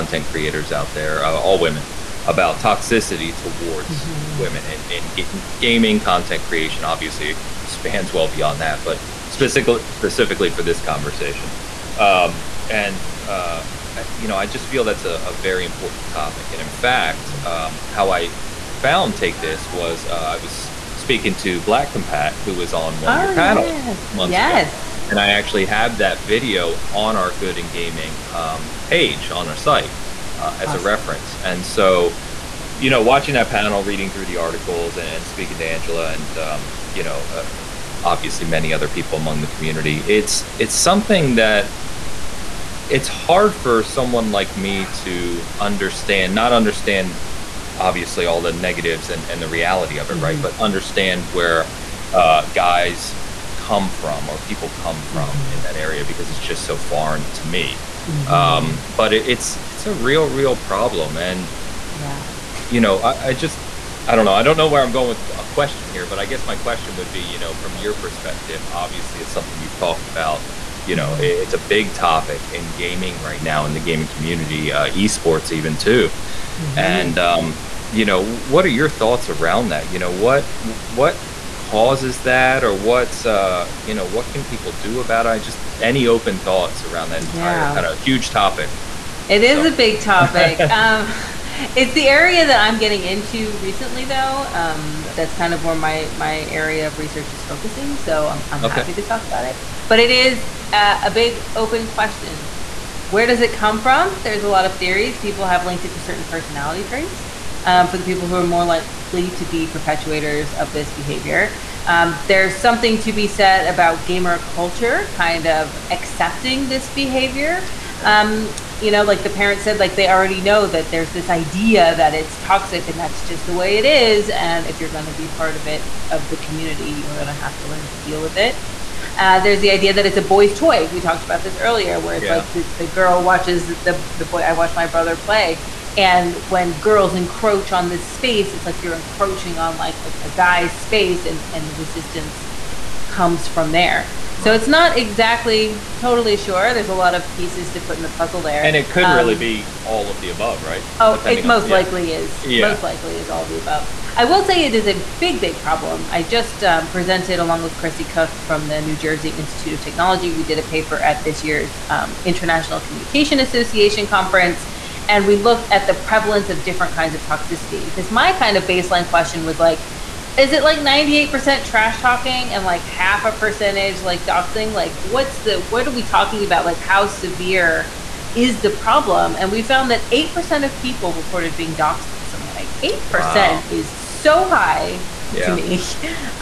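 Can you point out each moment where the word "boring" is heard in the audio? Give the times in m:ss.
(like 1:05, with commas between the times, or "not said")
not said.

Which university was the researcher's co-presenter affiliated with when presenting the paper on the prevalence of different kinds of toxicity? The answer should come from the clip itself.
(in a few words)
New Jersey Institute of Technology.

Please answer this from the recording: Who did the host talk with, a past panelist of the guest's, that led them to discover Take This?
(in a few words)
Black Compat.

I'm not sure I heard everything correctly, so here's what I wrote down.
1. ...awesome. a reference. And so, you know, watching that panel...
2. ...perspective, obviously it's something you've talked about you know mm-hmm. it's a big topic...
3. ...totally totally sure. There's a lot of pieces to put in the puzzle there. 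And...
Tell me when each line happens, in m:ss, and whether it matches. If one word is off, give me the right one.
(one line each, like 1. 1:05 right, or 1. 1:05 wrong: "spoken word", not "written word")
1. 0:30 right
2. 1:08 right
3. 2:24 wrong: "exactly", not "totally".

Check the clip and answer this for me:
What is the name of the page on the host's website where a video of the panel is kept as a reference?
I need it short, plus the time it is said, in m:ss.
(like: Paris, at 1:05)
Good in Gaming, at 0:27.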